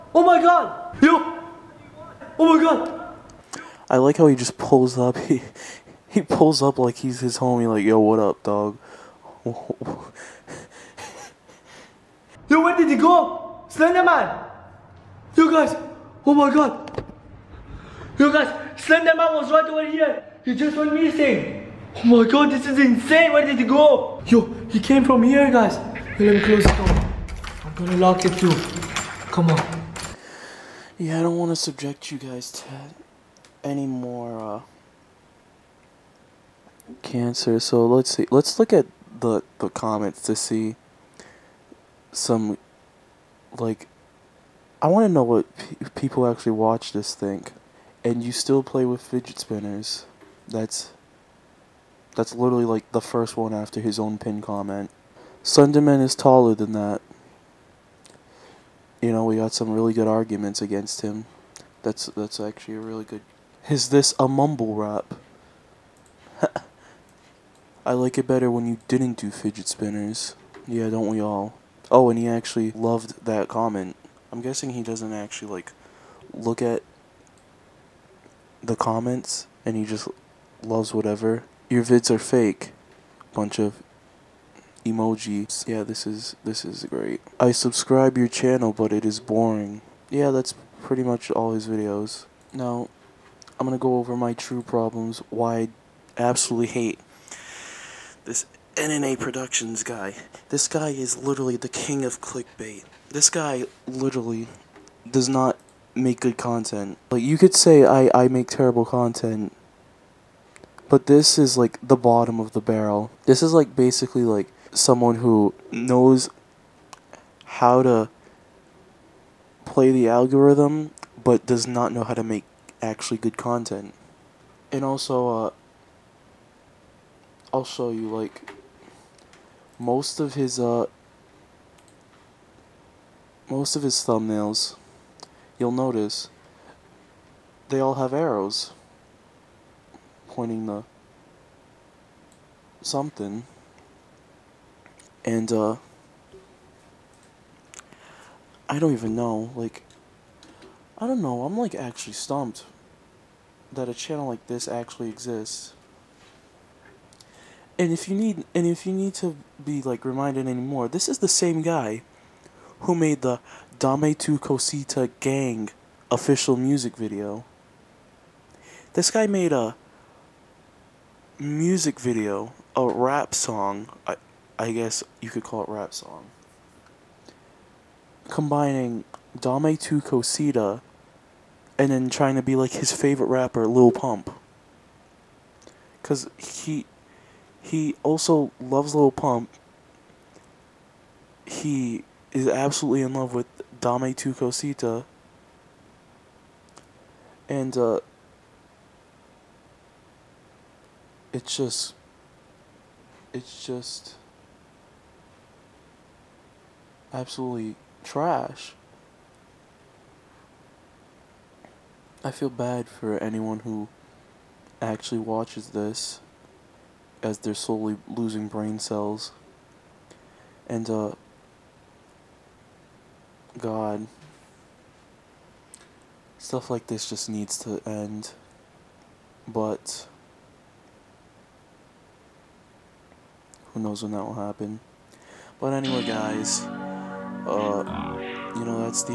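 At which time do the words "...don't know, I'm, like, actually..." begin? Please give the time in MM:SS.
02:31.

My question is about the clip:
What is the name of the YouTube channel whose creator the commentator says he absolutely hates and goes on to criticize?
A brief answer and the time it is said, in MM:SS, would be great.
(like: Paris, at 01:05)
N&A Productions, at 01:38.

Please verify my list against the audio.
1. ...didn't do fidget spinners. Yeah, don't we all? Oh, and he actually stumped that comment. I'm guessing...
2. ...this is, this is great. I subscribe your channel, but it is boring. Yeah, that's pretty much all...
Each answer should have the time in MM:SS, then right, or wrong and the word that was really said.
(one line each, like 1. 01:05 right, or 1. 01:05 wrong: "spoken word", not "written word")
1. 01:08 wrong: "loved", not "stumped"
2. 01:25 right.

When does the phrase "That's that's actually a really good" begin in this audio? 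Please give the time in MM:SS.
01:01.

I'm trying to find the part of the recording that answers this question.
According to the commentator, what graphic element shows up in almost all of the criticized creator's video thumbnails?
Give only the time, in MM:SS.
02:18.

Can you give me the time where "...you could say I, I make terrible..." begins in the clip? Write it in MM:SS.
01:47.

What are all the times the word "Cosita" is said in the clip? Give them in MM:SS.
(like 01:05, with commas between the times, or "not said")
02:44, 03:00, 03:14.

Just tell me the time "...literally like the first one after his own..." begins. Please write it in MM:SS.
00:52.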